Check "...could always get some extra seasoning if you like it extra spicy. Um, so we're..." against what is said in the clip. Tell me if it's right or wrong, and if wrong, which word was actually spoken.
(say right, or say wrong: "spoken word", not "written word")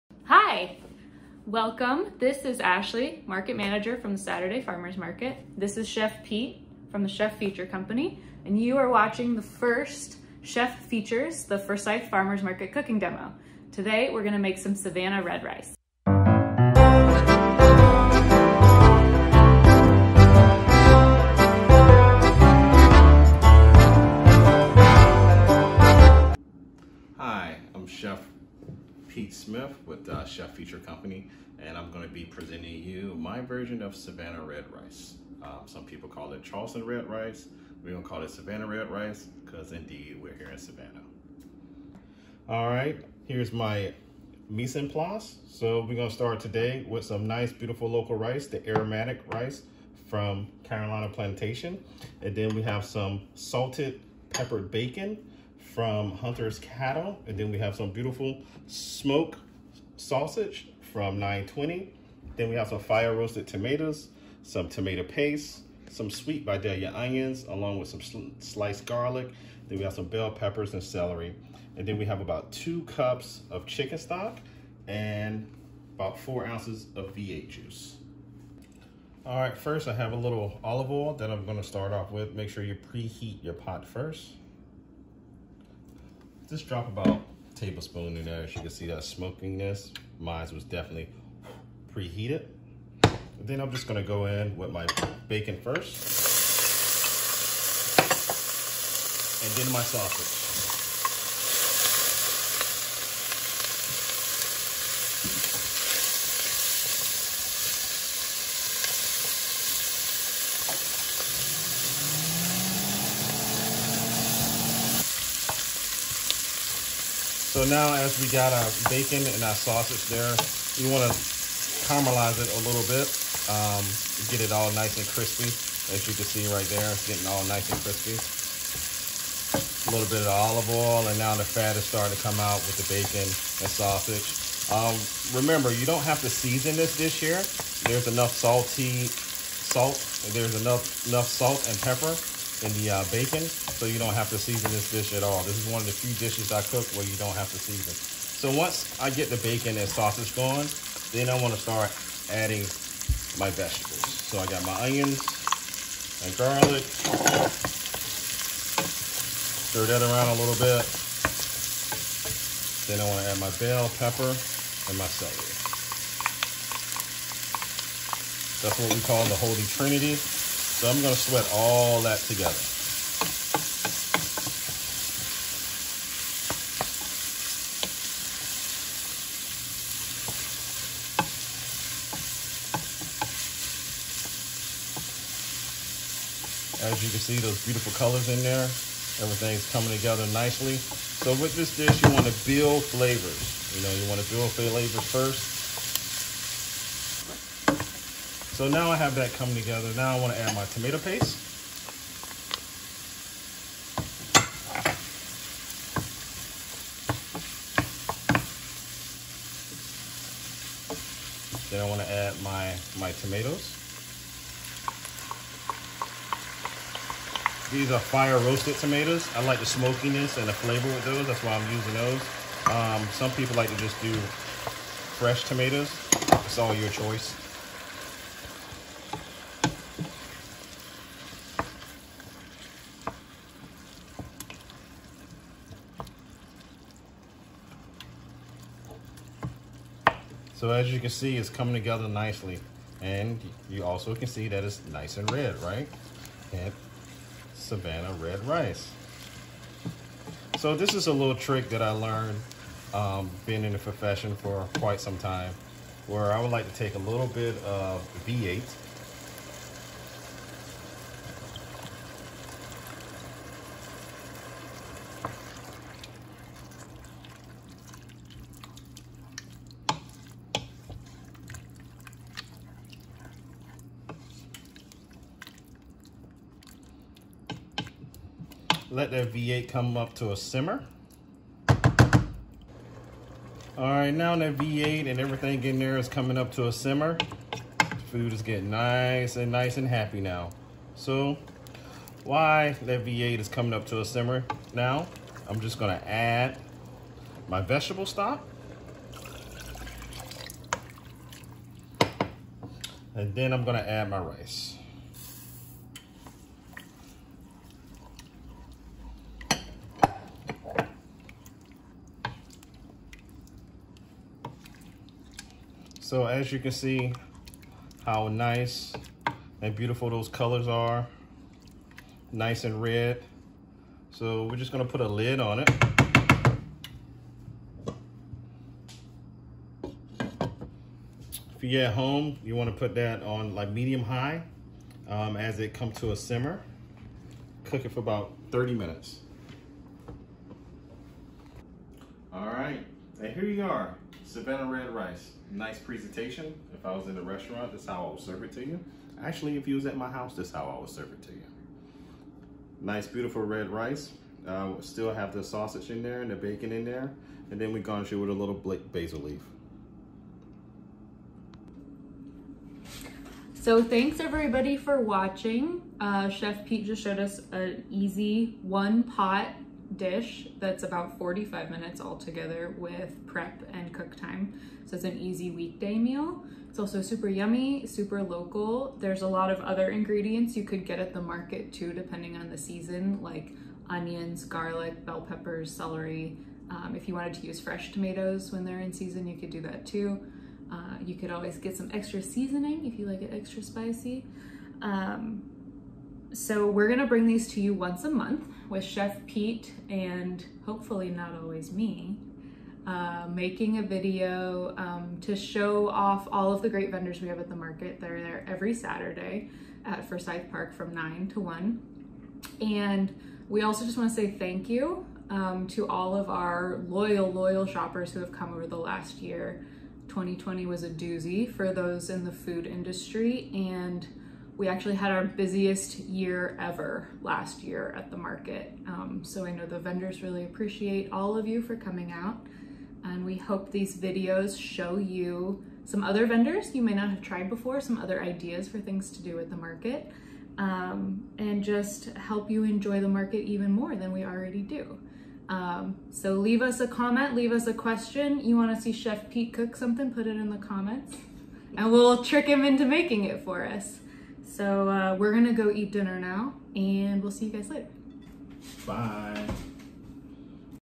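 right.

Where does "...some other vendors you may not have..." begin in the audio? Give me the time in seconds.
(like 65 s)
435 s.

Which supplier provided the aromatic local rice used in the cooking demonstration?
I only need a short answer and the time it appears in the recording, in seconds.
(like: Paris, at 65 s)
Carolina Plantation, at 50 s.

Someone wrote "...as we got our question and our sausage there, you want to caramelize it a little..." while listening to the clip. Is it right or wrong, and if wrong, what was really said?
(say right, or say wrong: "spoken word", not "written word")
wrong: "bacon", not "question".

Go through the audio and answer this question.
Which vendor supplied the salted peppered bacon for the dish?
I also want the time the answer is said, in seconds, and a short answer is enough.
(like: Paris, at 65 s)
Hunter's Cattle, at 56 s.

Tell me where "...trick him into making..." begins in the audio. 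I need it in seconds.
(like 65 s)
452 s.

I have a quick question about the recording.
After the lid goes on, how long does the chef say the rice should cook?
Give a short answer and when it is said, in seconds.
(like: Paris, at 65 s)
30 minutes, at 338 s.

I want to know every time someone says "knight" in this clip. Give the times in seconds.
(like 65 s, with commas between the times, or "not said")
not said.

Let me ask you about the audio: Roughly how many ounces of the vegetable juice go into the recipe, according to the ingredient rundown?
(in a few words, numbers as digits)
4.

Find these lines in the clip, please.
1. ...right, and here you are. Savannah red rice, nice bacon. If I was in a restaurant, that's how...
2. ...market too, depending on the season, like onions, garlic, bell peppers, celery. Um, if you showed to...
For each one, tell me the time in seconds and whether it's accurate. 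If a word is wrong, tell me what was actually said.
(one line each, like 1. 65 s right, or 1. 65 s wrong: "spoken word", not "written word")
1. 342 s wrong: "presentation", not "bacon"
2. 381 s wrong: "wanted", not "showed".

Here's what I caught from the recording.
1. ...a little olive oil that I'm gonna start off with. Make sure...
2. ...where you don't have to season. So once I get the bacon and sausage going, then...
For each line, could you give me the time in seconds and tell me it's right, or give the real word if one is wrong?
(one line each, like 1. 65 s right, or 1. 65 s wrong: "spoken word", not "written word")
1. 80 s right
2. 146 s right.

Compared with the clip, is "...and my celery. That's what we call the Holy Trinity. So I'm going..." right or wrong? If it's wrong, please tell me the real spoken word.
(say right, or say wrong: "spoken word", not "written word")
right.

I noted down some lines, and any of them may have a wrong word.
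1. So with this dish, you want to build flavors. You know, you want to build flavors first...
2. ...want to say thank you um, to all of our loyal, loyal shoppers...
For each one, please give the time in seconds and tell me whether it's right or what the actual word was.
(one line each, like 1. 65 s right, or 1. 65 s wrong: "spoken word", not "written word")
1. 190 s right
2. 413 s right.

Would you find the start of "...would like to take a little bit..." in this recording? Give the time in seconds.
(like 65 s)
256 s.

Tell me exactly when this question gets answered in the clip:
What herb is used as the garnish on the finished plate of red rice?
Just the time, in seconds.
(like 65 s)
358 s.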